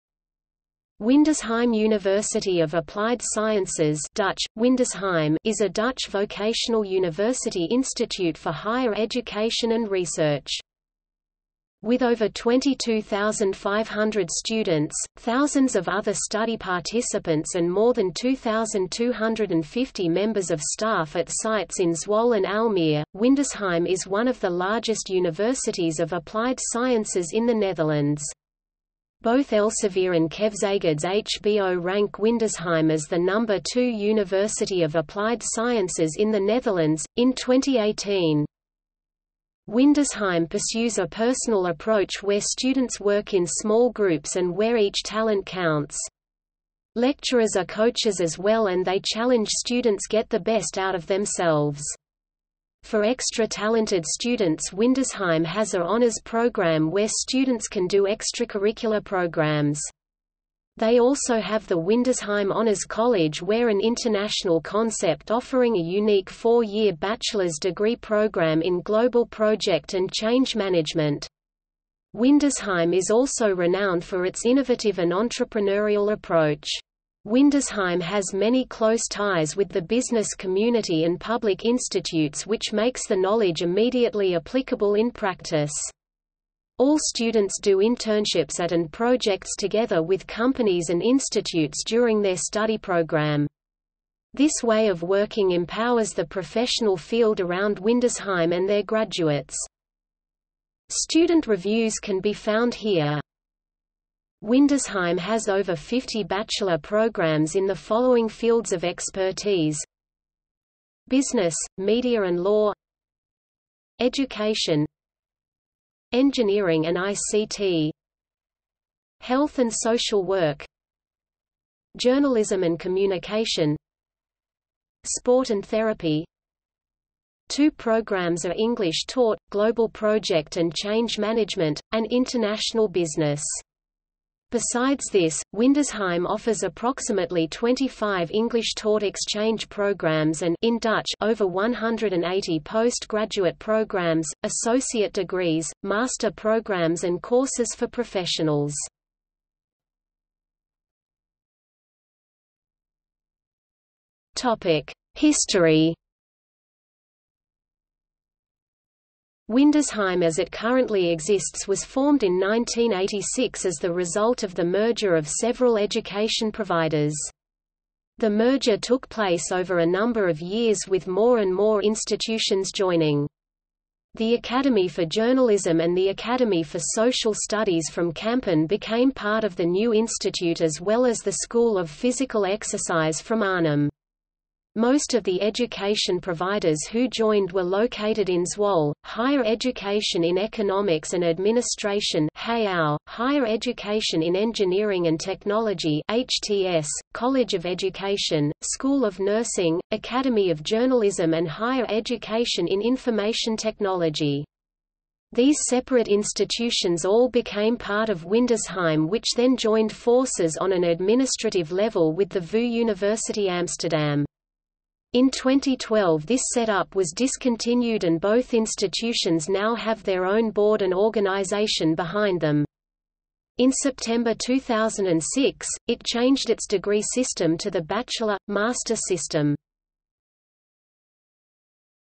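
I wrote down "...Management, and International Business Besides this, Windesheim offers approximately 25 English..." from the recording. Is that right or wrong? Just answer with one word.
right.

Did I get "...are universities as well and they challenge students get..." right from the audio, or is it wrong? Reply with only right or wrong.
wrong.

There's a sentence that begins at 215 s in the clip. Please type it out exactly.
In 2012 this setup was discontinued and both institutions now have their own board and organization behind them.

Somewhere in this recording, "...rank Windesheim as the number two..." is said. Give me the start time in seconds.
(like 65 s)
31 s.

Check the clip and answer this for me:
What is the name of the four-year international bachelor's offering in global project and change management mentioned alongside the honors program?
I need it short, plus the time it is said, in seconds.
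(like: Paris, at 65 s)
Windesheim Honors College, at 61 s.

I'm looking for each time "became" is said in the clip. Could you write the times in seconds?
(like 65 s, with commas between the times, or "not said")
178 s, 207 s.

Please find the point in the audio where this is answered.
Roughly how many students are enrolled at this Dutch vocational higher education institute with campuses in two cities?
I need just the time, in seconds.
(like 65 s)
12 s.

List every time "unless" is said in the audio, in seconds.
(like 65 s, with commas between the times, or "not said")
not said.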